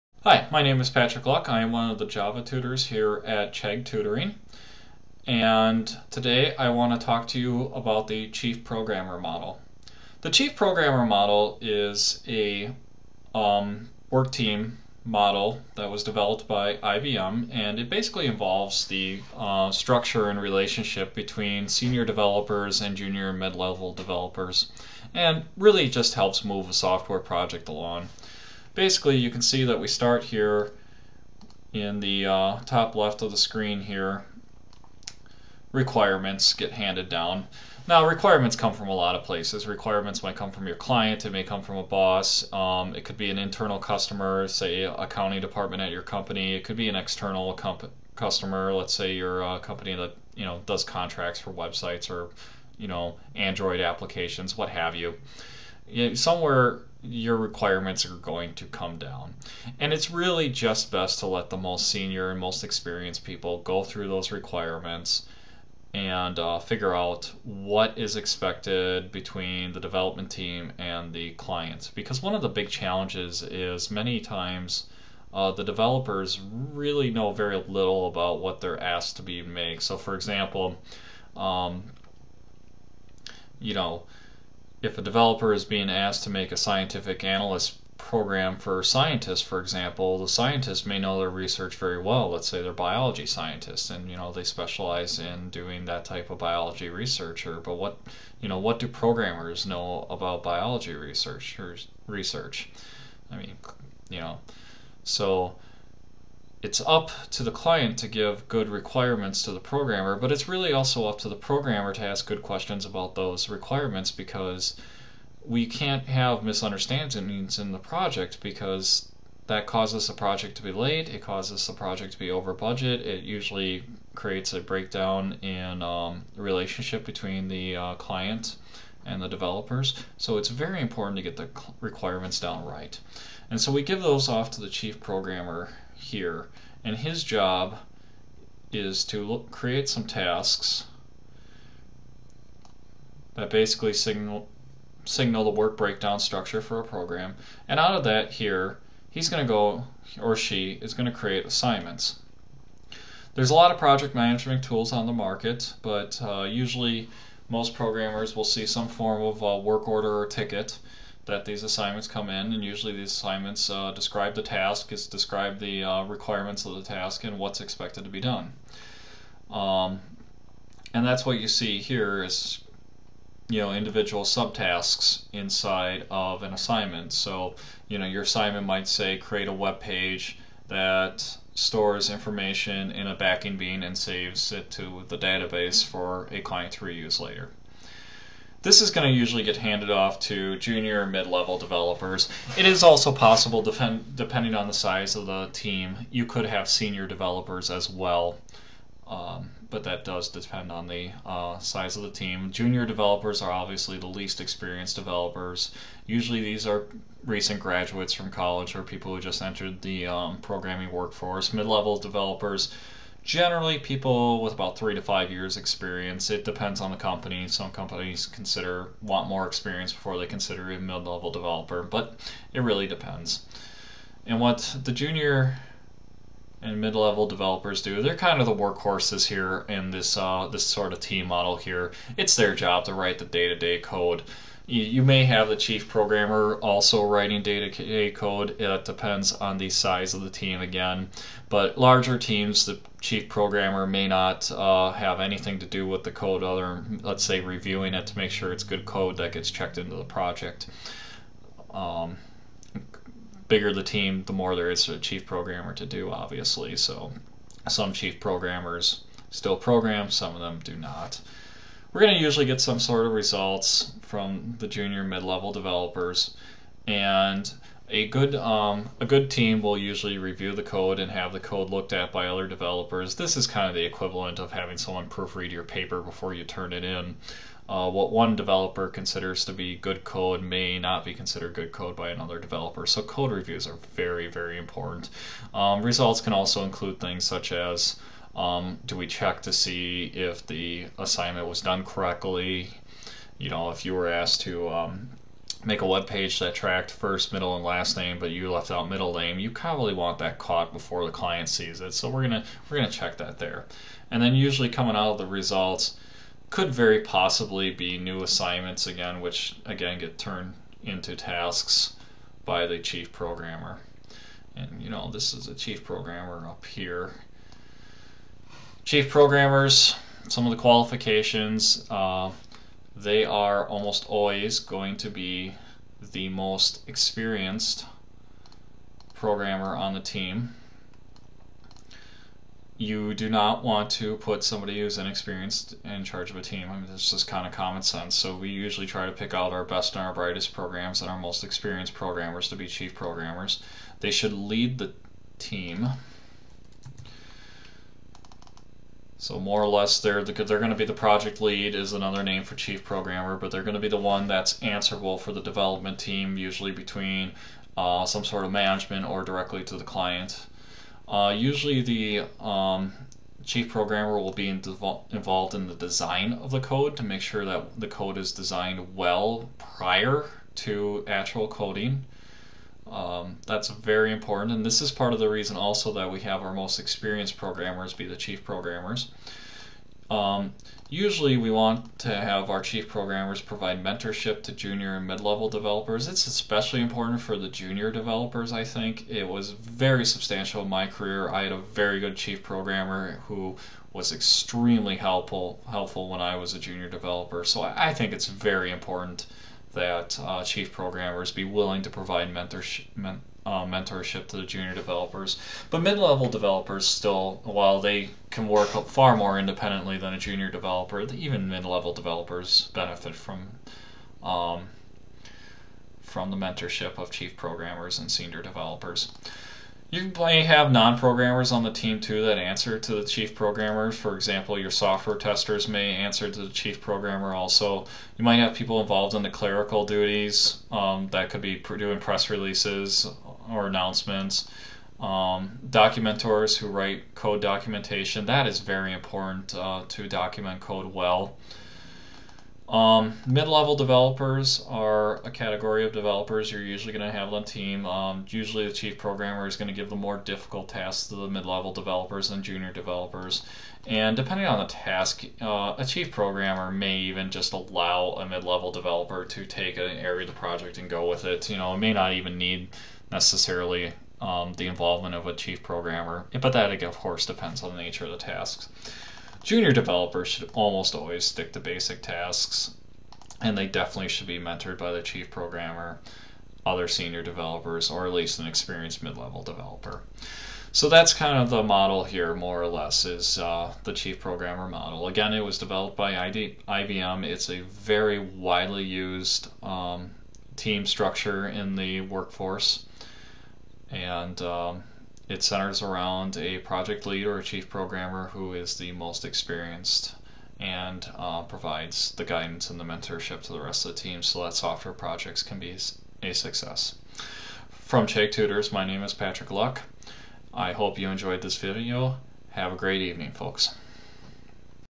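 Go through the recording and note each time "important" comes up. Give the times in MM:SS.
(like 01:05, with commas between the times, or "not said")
02:10, 04:44, 06:14, 06:26, 06:38, 07:18.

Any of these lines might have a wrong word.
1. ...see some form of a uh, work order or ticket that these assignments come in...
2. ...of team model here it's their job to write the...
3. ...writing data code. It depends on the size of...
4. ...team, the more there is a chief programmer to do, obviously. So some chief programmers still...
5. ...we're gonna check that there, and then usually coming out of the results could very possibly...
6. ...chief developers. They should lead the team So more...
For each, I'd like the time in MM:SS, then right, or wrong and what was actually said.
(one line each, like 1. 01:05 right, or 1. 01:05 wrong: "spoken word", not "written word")
1. 02:38 right
2. 03:50 right
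3. 03:57 right
4. 04:13 right
5. 05:02 right
6. 05:42 wrong: "programmers", not "developers".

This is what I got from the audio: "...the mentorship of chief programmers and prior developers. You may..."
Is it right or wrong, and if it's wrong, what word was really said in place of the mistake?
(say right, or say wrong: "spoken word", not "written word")
wrong: "senior", not "prior".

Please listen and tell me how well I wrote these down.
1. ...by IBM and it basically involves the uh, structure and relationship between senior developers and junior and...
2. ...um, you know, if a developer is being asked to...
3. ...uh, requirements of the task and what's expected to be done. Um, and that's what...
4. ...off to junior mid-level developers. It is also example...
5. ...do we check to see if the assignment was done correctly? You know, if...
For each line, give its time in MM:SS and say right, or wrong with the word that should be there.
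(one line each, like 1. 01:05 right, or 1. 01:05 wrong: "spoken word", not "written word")
1. 00:16 right
2. 01:21 right
3. 02:45 right
4. 03:09 wrong: "possible", not "example"
5. 04:48 right.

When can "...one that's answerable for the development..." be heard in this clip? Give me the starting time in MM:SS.
05:54.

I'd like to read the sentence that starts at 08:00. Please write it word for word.
So that's kind of the model here, more or less, is uh, the chief programmer model.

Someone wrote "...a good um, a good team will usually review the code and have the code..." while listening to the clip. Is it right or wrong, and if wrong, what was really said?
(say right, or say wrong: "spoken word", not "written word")
right.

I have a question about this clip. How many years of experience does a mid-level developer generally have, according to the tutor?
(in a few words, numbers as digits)
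3 to 5 years.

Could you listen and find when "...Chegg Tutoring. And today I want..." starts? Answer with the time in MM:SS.
00:03.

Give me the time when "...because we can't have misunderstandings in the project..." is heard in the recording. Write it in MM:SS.
01:54.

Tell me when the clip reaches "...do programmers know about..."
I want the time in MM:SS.
01:38.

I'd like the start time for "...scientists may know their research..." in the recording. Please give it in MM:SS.
01:30.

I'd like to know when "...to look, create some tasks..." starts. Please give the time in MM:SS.
02:19.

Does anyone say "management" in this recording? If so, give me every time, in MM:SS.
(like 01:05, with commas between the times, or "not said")
02:34, 05:58.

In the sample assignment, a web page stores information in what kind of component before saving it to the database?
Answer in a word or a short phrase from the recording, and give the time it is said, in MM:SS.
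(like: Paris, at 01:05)
backing bean, at 03:03.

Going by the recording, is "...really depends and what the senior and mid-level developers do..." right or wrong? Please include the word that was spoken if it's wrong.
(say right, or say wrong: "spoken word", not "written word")
wrong: "junior", not "senior".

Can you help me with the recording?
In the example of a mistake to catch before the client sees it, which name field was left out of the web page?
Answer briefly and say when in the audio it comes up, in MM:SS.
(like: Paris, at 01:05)
middle name, at 04:58.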